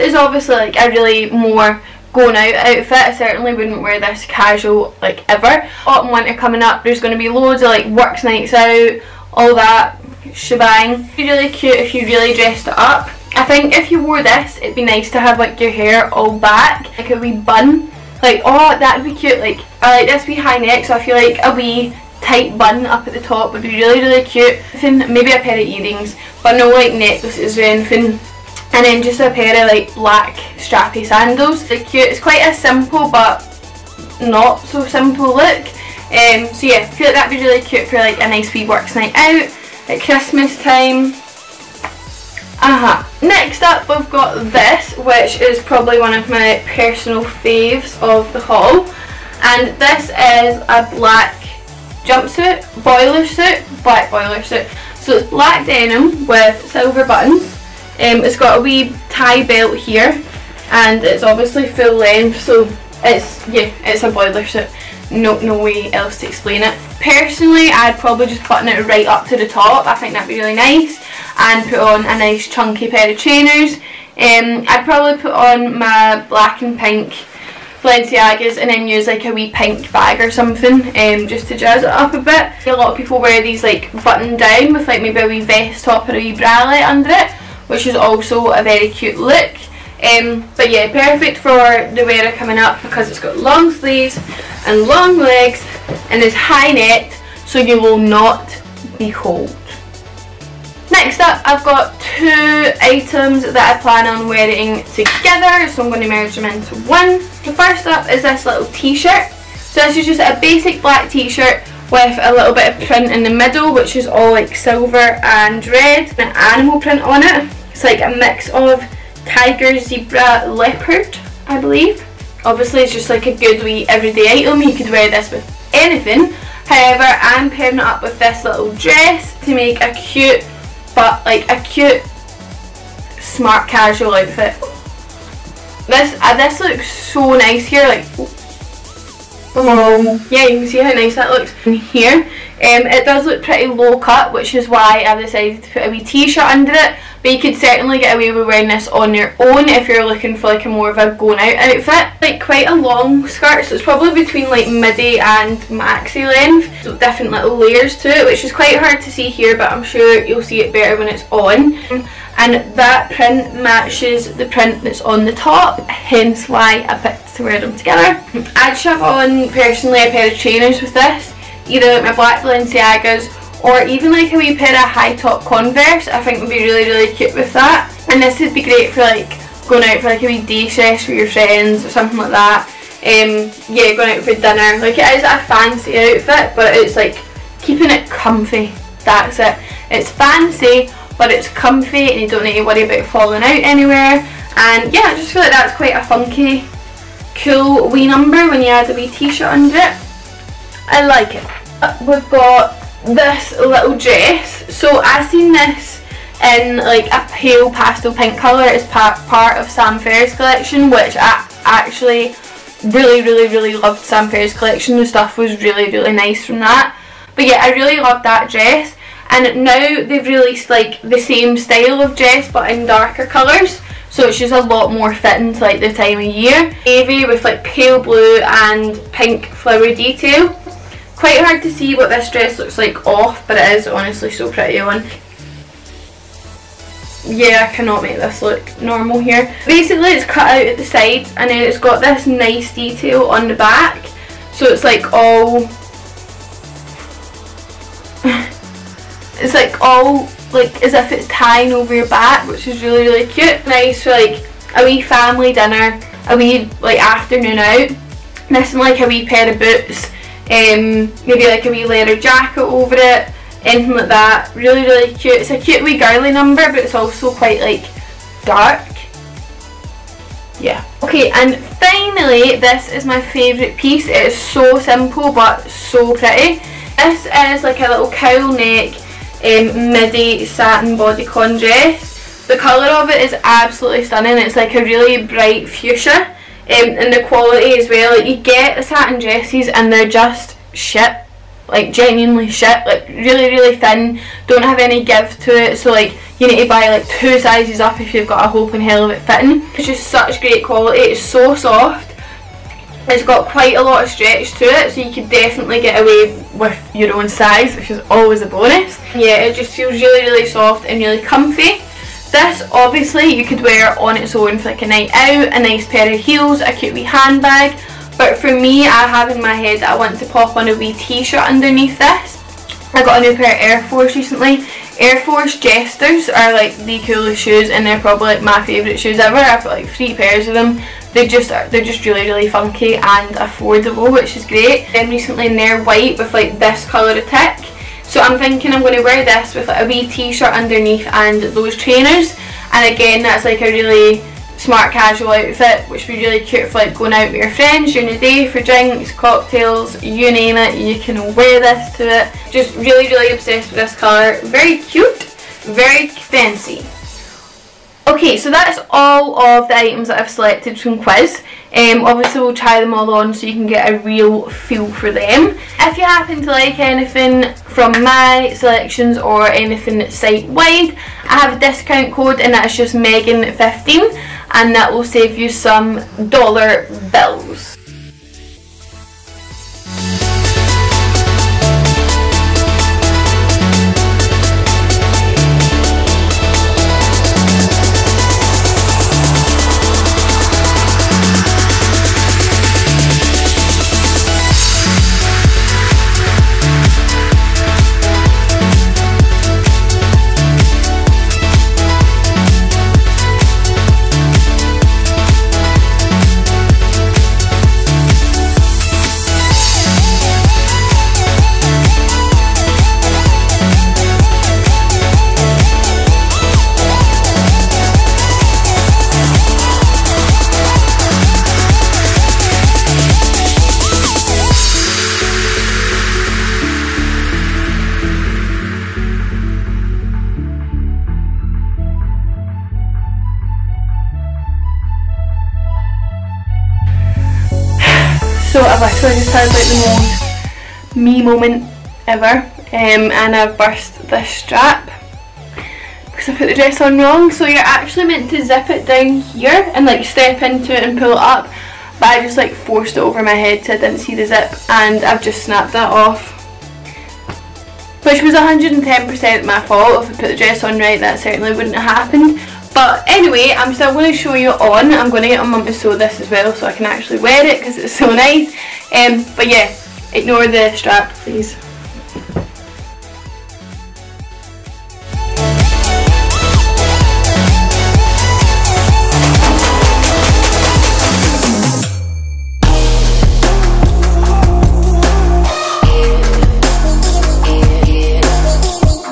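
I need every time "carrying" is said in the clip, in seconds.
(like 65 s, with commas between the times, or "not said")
not said.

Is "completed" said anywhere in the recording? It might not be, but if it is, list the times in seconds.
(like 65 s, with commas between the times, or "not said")
not said.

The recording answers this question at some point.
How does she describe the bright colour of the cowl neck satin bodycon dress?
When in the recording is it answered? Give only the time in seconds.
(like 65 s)
285 s.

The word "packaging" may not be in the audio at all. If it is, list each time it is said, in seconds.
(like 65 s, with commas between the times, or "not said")
not said.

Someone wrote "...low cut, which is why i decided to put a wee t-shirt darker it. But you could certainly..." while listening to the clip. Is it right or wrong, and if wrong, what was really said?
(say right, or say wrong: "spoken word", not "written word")
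wrong: "under", not "darker".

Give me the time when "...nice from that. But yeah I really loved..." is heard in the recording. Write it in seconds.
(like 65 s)
216 s.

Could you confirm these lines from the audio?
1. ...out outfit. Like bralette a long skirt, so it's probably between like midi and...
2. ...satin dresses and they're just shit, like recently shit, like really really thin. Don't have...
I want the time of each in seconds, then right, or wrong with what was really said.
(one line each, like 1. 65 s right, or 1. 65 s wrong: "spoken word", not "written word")
1. 151 s wrong: "quite", not "bralette"
2. 288 s wrong: "genuinely", not "recently".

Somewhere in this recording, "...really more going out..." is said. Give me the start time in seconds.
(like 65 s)
0 s.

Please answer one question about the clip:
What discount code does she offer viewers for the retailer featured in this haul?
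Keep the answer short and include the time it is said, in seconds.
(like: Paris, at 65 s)
Megan15, at 372 s.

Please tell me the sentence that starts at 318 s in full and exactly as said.
But for me, I have in my head that I want to pop on a wee t-shirt underneath this.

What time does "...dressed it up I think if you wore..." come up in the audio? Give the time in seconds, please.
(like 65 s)
12 s.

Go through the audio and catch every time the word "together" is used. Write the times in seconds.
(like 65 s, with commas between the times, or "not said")
104 s, 167 s.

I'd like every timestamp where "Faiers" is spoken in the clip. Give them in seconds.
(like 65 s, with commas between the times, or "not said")
209 s, 214 s.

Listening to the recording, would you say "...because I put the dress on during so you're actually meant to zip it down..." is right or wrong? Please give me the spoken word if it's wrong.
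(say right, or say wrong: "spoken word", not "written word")
wrong: "wrong", not "during".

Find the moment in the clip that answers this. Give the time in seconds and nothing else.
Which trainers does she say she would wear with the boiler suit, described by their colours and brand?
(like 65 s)
76 s.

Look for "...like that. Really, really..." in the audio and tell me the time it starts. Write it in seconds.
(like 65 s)
263 s.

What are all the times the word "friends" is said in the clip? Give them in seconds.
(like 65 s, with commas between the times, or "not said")
181 s, 347 s.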